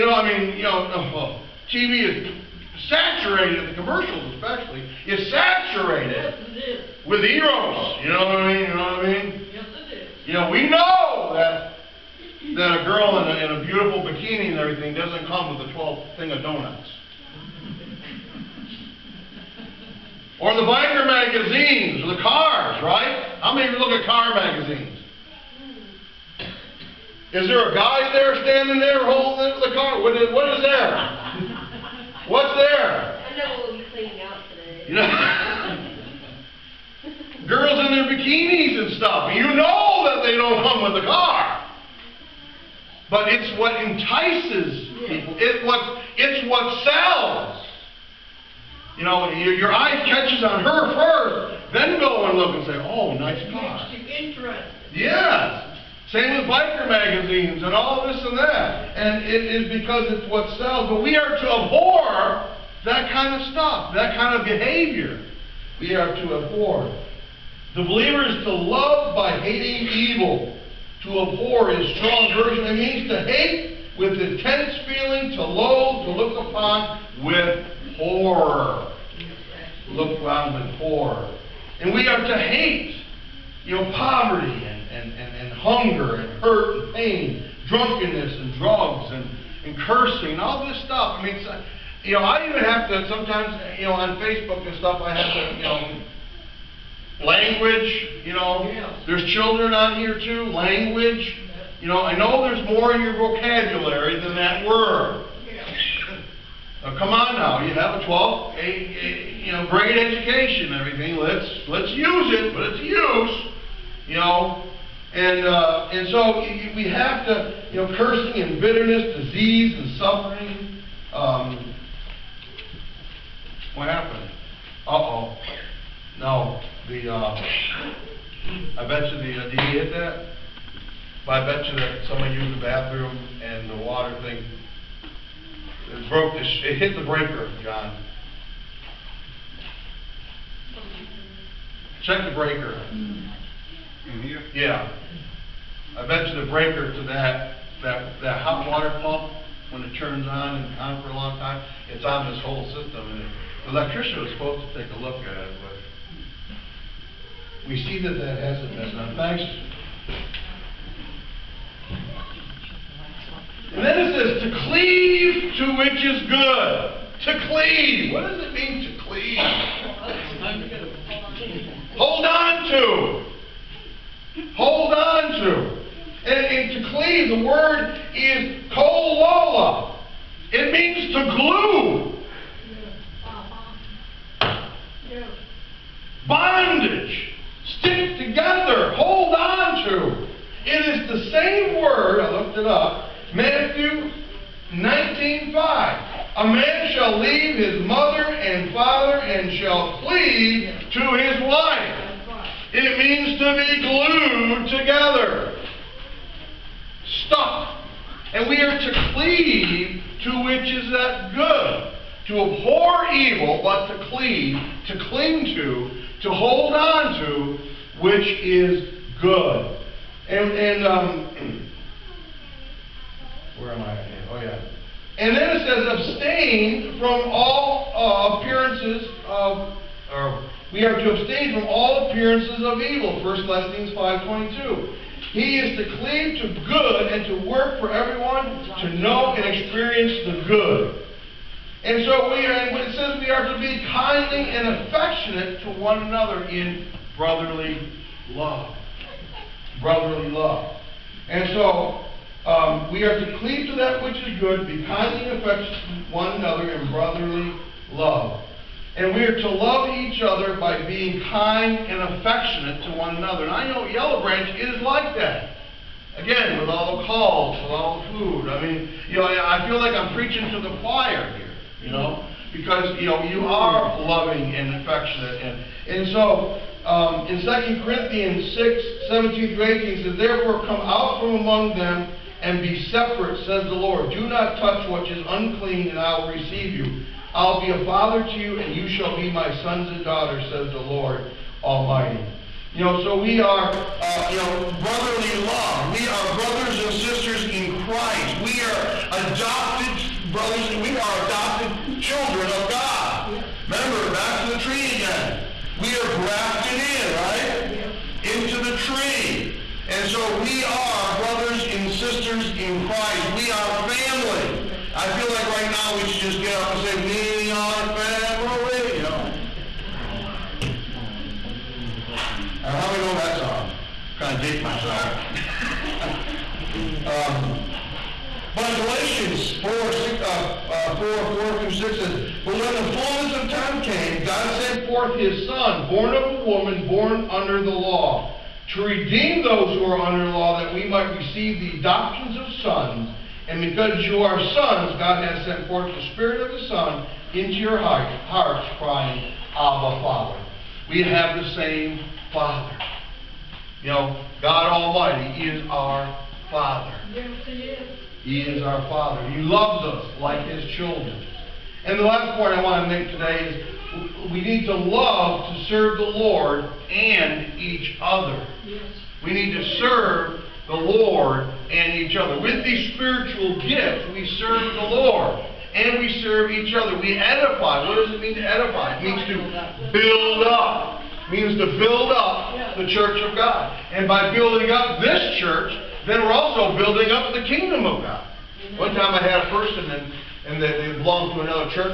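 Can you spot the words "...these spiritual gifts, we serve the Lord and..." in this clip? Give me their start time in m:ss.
6:12.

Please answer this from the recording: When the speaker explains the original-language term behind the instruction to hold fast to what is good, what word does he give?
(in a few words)
kolola.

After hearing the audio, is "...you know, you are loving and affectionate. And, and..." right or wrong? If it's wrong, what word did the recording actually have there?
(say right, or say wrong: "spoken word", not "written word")
right.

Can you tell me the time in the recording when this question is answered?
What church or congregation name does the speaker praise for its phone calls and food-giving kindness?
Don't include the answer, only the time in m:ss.
4:23.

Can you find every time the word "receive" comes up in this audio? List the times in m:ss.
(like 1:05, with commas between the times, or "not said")
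4:46, 5:41.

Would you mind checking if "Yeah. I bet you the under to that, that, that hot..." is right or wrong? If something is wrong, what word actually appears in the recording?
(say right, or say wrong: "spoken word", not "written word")
wrong: "breaker", not "under".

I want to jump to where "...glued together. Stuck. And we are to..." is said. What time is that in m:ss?
3:23.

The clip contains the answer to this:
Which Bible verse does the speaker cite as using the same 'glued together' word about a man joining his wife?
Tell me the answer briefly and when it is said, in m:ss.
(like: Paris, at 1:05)
Matthew 19:5, at 3:13.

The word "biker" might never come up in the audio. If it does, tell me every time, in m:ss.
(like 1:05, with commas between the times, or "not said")
0:20, 0:56.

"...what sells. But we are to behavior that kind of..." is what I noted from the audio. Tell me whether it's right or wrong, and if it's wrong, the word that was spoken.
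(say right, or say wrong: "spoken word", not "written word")
wrong: "abhor", not "behavior".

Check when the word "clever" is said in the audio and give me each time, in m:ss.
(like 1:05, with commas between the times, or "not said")
not said.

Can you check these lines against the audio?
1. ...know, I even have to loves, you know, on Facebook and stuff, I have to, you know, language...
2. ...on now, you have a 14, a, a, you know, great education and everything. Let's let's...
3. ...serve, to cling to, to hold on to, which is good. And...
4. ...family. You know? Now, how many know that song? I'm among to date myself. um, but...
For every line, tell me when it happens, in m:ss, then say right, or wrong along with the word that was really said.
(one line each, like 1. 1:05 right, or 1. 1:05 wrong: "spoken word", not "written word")
1. 1:32 wrong: "sometimes", not "loves"
2. 1:47 wrong: "12", not "14"
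3. 3:34 wrong: "cleave", not "serve"
4. 5:17 wrong: "trying", not "among".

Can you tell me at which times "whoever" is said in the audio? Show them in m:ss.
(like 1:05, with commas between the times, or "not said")
not said.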